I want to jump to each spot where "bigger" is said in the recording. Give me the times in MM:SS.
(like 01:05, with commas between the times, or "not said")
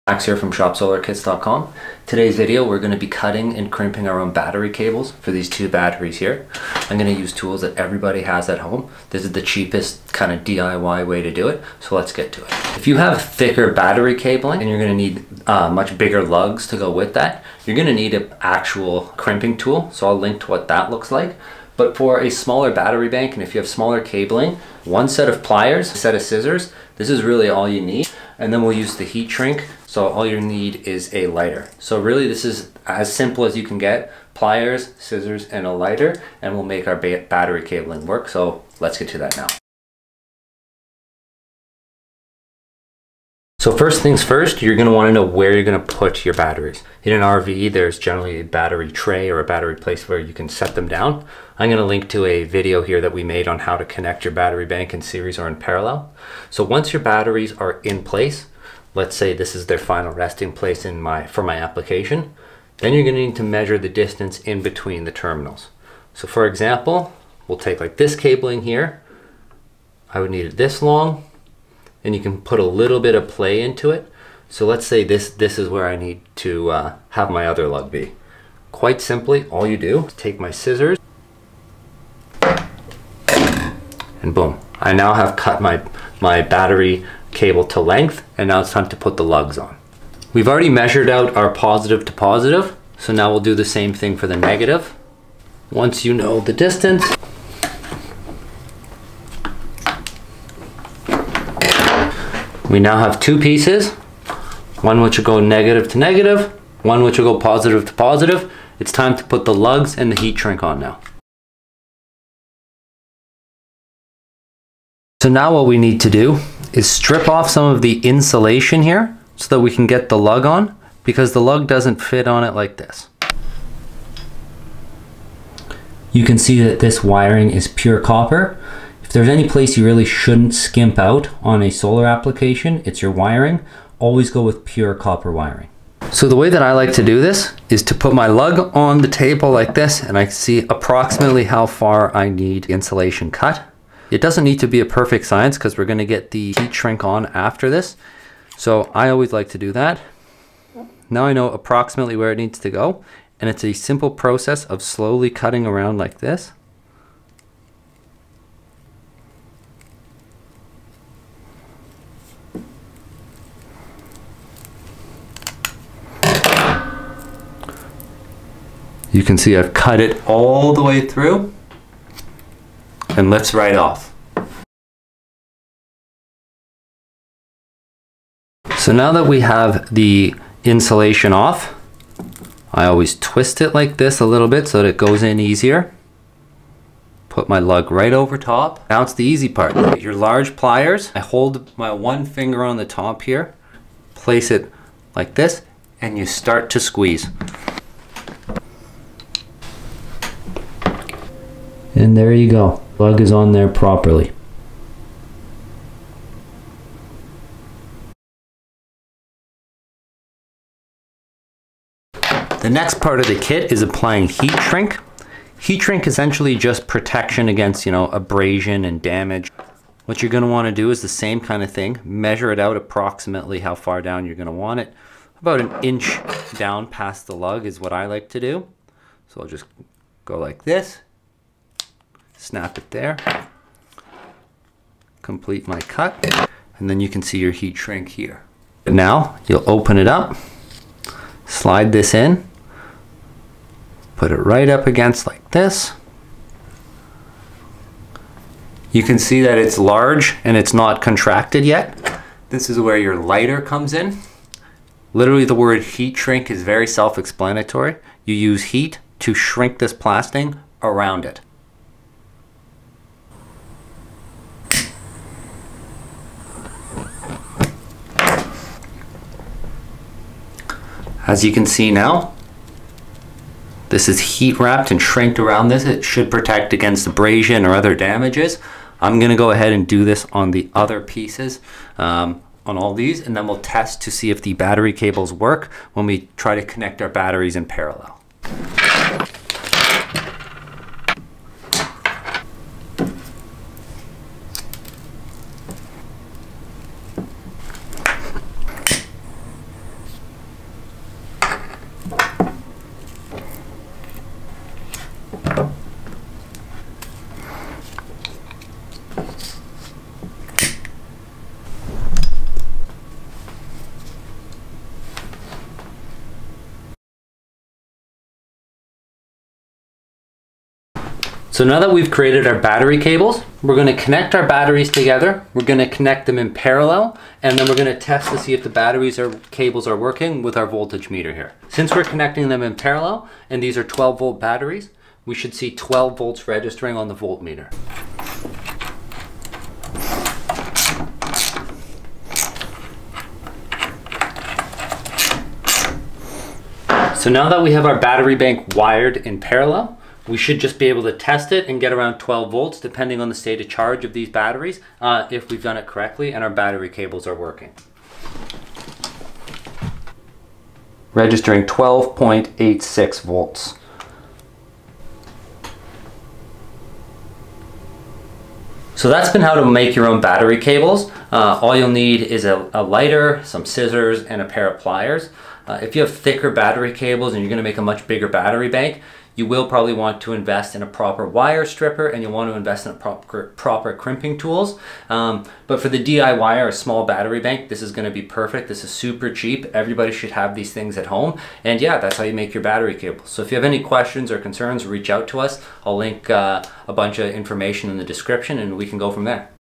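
00:15, 06:18.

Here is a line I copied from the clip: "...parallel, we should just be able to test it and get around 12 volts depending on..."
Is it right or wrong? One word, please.
right.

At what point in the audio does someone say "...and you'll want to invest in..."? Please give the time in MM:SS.
06:22.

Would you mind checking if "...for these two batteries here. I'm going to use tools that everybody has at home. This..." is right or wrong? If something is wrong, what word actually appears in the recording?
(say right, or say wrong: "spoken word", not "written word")
right.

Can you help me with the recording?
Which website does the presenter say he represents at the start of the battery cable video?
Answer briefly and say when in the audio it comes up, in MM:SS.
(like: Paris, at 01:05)
shopsolarkits.com, at 00:00.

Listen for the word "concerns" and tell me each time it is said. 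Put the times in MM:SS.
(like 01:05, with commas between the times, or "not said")
06:34.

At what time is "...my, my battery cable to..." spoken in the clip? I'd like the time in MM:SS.
01:25.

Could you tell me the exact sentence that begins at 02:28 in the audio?
So I always like to do that.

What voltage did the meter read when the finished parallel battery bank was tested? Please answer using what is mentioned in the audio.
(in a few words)
12.86 volts.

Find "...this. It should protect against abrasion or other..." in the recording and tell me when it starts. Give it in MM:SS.
04:35.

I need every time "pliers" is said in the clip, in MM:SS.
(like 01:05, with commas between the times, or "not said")
00:25, 00:34, 03:10, 06:14.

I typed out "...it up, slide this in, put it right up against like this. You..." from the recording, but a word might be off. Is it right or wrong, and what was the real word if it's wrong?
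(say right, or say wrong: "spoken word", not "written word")
right.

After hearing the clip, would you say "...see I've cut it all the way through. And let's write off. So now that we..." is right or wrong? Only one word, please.
right.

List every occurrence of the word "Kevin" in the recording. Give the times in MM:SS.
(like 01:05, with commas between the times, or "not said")
not said.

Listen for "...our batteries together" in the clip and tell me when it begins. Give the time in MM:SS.
05:24.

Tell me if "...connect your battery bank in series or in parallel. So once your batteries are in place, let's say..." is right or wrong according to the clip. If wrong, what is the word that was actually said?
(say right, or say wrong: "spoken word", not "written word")
right.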